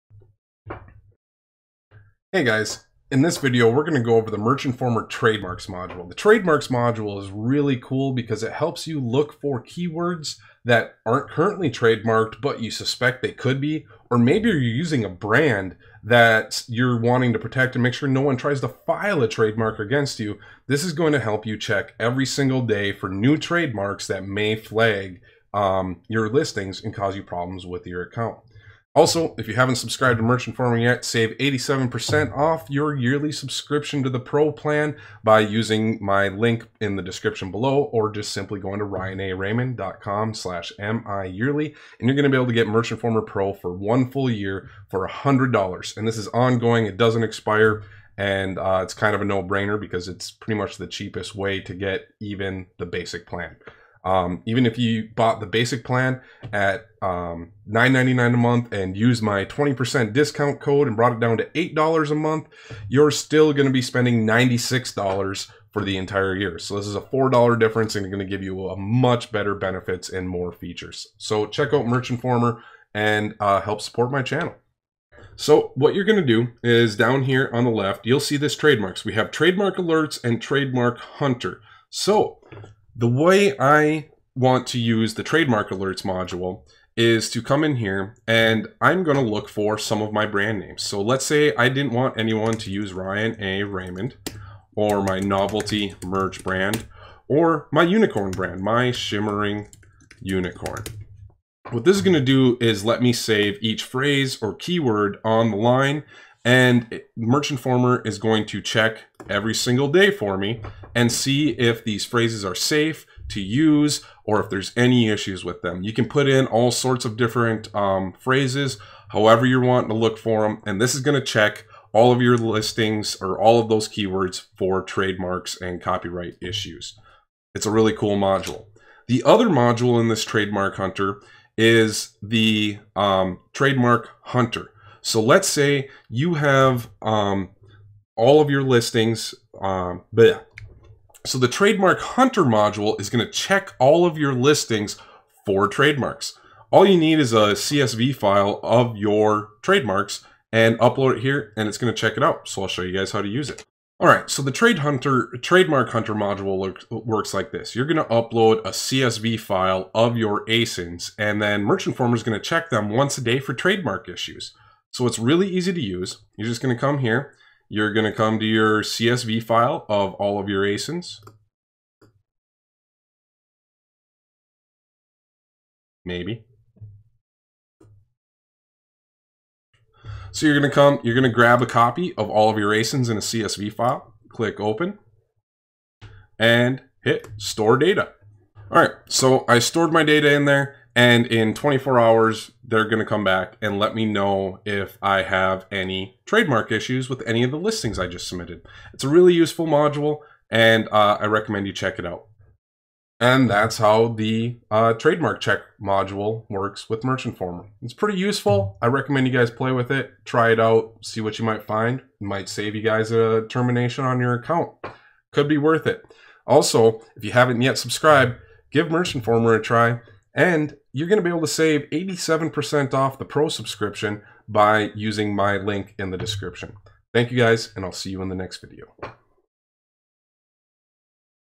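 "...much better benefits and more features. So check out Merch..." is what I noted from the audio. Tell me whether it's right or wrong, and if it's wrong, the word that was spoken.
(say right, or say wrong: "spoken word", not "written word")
right.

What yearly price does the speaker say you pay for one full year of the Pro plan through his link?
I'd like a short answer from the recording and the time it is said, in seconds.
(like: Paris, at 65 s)
$100, at 45 s.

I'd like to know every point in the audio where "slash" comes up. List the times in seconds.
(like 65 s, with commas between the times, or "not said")
40 s.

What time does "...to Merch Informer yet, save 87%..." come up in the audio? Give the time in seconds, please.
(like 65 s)
30 s.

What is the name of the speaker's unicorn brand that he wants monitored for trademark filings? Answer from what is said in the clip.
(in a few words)
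shimmering unicorn.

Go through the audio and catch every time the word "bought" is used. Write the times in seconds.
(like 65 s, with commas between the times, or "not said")
55 s.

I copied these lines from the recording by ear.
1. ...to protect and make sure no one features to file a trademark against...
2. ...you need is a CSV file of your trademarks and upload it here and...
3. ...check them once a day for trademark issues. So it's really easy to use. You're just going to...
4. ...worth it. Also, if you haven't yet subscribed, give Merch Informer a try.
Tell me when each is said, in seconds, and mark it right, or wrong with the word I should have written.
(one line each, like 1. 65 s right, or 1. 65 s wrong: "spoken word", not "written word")
1. 17 s wrong: "tries", not "features"
2. 146 s right
3. 162 s right
4. 215 s right.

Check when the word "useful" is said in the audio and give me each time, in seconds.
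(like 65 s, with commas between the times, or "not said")
199 s, 208 s.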